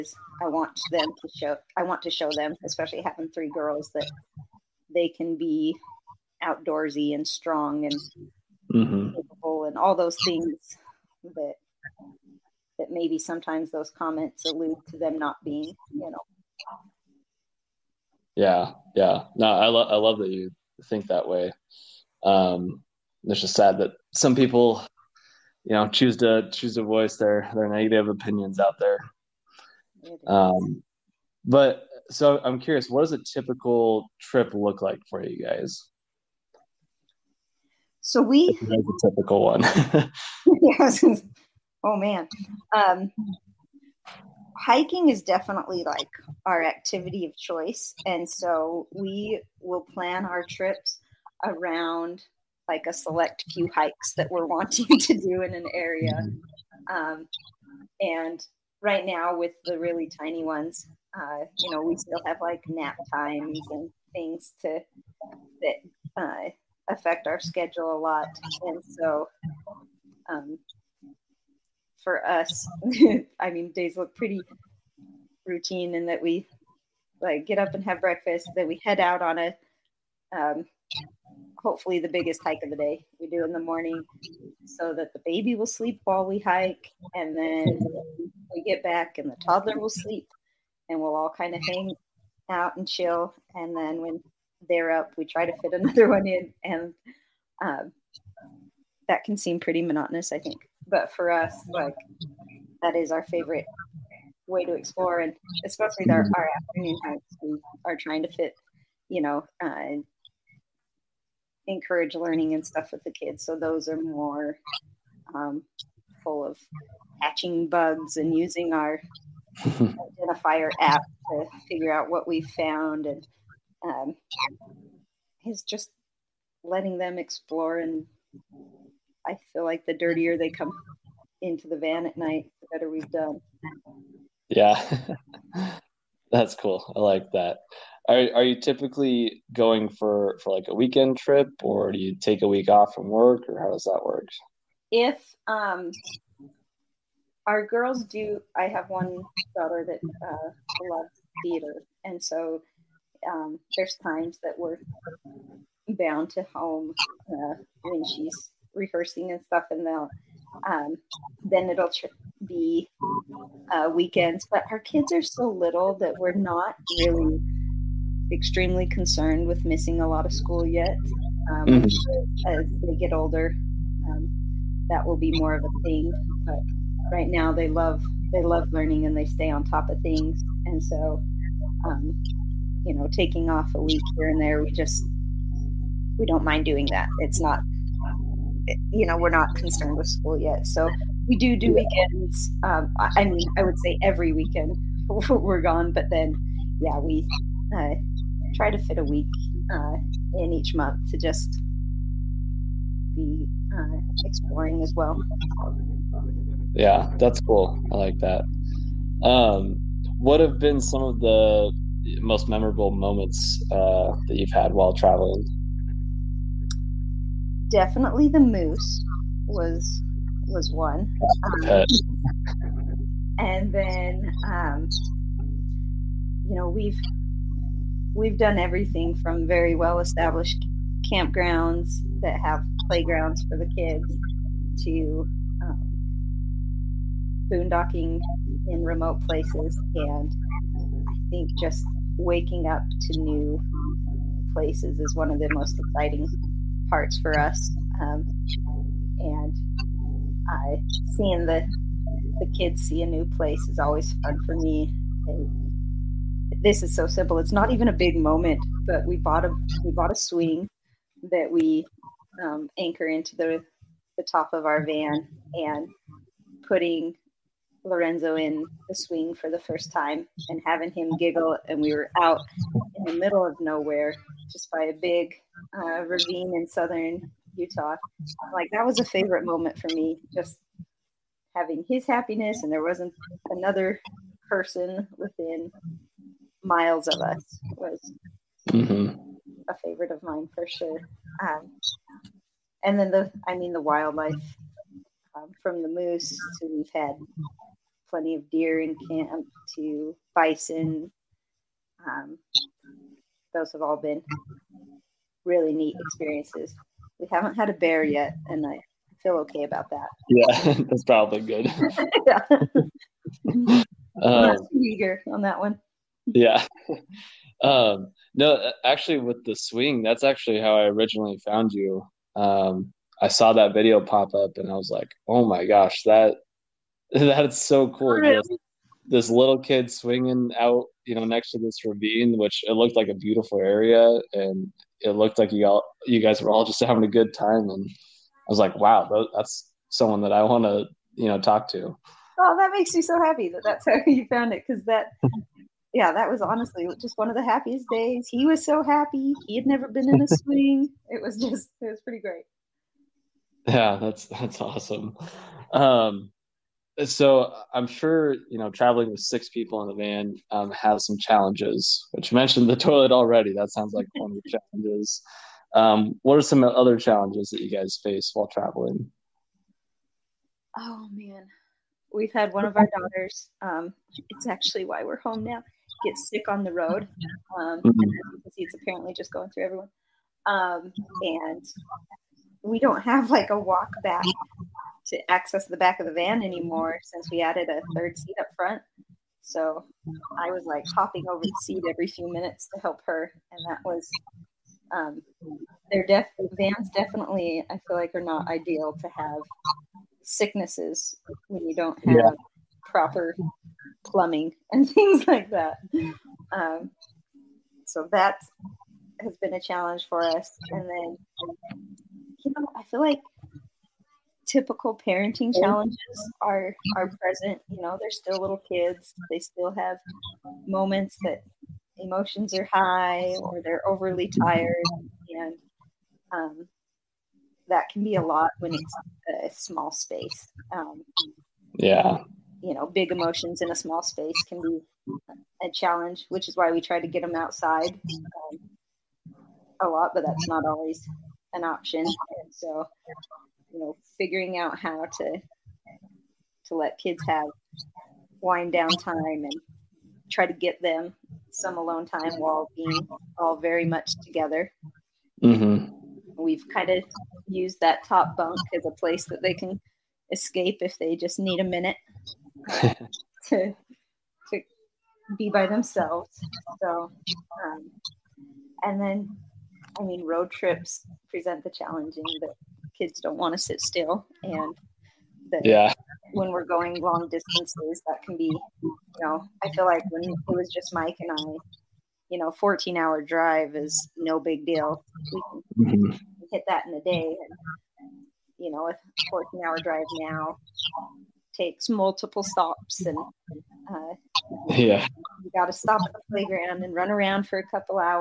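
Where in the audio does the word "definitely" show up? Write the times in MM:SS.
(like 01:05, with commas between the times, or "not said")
00:45, 03:37, 06:36.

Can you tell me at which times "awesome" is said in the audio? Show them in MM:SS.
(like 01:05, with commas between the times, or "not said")
05:54.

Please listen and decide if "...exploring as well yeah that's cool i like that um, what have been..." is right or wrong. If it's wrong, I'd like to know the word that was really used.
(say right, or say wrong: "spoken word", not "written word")
right.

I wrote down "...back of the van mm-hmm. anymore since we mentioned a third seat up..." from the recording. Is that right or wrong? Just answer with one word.
wrong.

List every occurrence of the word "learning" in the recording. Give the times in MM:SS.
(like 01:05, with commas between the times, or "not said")
01:52, 02:58.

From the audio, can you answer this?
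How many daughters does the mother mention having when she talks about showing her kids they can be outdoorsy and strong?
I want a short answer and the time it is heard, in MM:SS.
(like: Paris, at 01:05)
3, at 00:03.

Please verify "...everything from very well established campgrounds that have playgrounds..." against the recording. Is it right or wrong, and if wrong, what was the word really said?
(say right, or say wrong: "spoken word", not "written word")
right.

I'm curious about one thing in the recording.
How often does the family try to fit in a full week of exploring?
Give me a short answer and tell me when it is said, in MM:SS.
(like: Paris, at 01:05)
Each month, at 03:20.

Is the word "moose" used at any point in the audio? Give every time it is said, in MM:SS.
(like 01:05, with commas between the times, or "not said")
03:38, 04:55.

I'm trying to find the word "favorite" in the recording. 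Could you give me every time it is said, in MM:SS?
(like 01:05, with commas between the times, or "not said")
01:43, 04:39, 04:49.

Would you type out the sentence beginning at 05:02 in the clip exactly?
Um, those have all been really neat experiences.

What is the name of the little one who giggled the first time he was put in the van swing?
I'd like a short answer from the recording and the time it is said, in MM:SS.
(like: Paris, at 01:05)
Lorenzo, at 04:27.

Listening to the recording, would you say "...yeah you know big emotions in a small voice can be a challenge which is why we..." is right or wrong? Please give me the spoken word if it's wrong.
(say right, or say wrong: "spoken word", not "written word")
wrong: "space", not "voice".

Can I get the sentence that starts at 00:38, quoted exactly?
So we That's a typical one.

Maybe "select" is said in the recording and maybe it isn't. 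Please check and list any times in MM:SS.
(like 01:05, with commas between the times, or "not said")
00:52.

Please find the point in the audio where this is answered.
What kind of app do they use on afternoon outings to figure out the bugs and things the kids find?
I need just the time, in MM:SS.
01:59.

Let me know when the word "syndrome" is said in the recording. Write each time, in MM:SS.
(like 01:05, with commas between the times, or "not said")
not said.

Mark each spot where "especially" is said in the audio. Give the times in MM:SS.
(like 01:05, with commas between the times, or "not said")
00:02, 01:45.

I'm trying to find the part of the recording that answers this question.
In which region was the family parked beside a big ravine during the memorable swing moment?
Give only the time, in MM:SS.
04:36.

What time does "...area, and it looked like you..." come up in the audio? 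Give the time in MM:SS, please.
05:33.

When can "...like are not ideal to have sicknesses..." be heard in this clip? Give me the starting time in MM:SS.
06:37.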